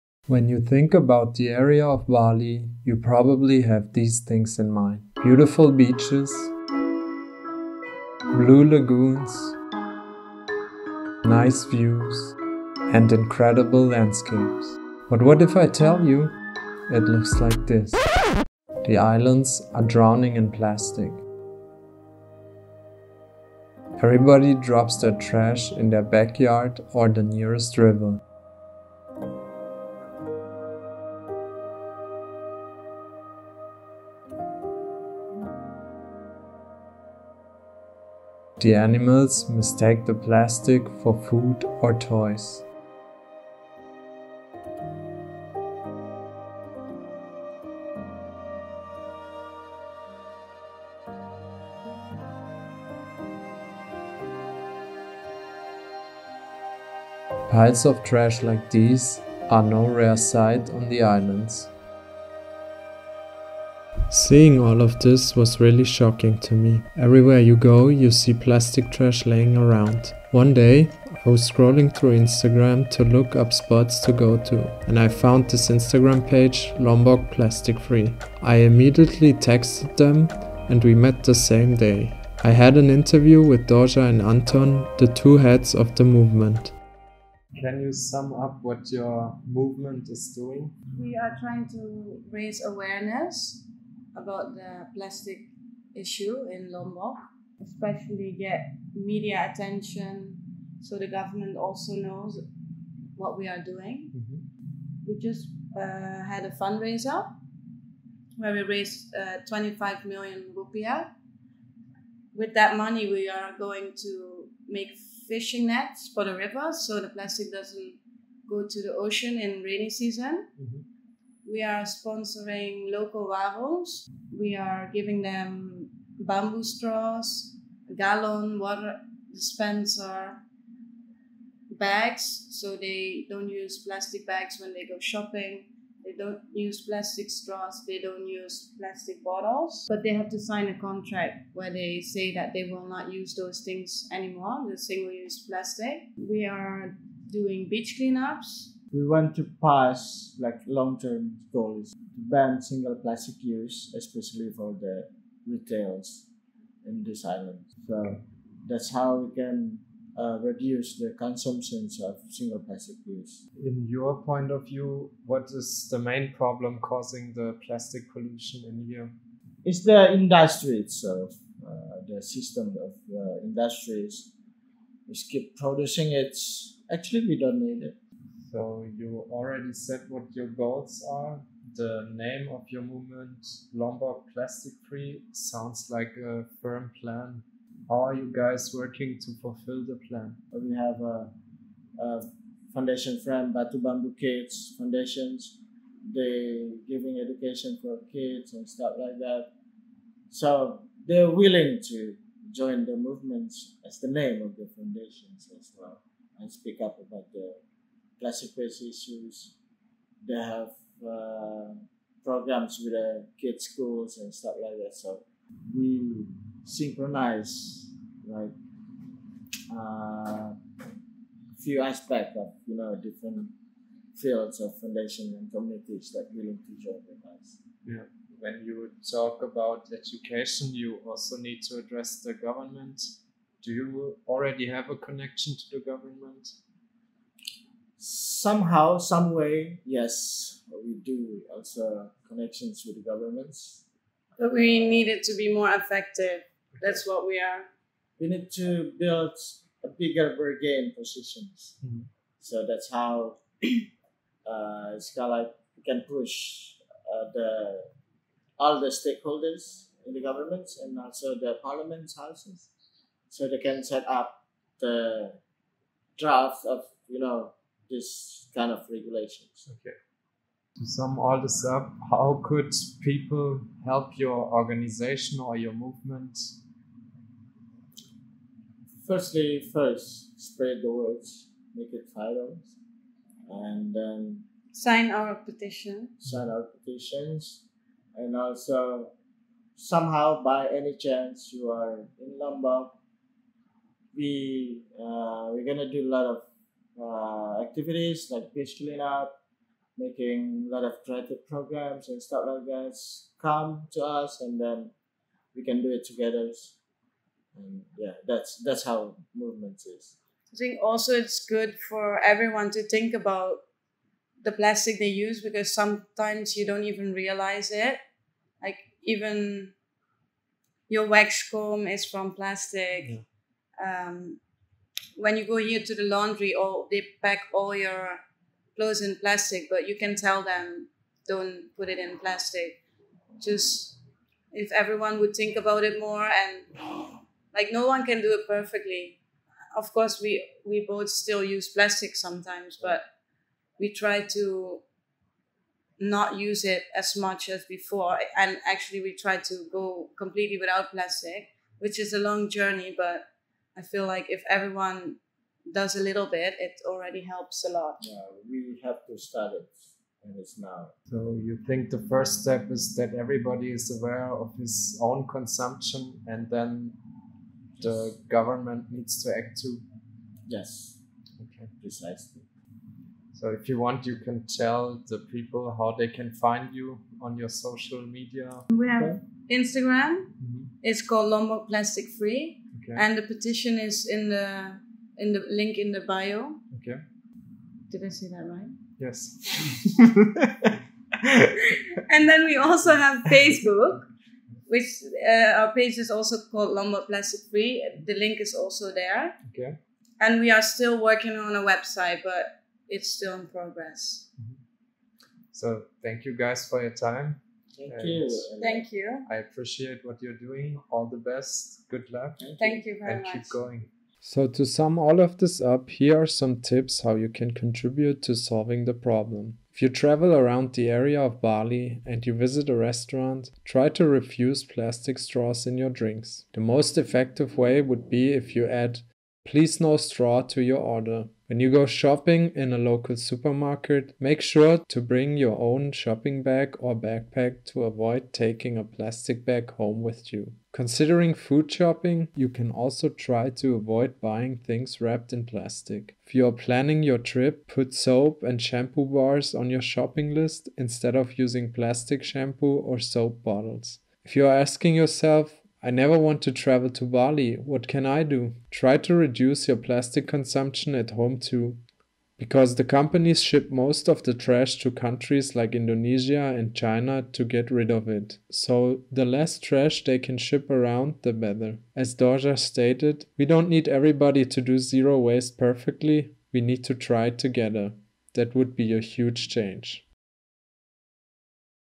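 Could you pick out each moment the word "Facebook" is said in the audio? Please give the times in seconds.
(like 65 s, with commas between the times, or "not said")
393 s.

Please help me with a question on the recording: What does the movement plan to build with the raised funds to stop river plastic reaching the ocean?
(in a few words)
fishing nets.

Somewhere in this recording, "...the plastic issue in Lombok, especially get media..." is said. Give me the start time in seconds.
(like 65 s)
94 s.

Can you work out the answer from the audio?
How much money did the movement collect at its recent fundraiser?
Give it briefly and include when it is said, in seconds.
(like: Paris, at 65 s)
25 million rupiah, at 109 s.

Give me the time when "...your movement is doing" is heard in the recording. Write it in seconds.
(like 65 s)
88 s.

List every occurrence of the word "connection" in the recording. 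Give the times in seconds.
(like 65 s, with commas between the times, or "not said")
234 s, 242 s.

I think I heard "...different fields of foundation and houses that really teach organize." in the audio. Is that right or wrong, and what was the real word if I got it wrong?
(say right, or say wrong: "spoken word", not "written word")
wrong: "communities", not "houses".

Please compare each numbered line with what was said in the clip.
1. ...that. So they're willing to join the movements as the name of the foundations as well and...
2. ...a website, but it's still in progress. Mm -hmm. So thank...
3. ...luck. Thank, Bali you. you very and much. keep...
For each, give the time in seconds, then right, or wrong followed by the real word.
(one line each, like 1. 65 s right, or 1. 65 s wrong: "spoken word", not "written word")
1. 199 s right
2. 401 s right
3. 412 s wrong: "Thank", not "Bali".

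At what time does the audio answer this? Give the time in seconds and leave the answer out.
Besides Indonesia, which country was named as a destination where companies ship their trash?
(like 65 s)
466 s.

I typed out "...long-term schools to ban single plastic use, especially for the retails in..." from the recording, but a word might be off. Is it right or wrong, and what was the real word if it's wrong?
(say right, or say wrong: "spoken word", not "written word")
wrong: "goals", not "schools".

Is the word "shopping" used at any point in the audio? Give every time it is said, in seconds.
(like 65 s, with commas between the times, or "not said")
134 s, 431 s, 435 s, 441 s, 449 s.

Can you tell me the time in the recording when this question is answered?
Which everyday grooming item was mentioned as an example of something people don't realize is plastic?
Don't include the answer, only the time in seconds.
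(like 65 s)
321 s.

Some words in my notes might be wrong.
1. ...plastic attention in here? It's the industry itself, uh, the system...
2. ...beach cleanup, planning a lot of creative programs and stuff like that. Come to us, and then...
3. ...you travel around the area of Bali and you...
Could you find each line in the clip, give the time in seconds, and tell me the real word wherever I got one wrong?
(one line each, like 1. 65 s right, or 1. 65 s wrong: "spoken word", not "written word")
1. 167 s wrong: "pollution", not "attention"
2. 298 s wrong: "making", not "planning"
3. 419 s right.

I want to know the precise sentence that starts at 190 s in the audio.
Uh, we have a, a foundation from Batu Bambu Kids Foundations.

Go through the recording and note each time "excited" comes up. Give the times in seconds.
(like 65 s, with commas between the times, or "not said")
not said.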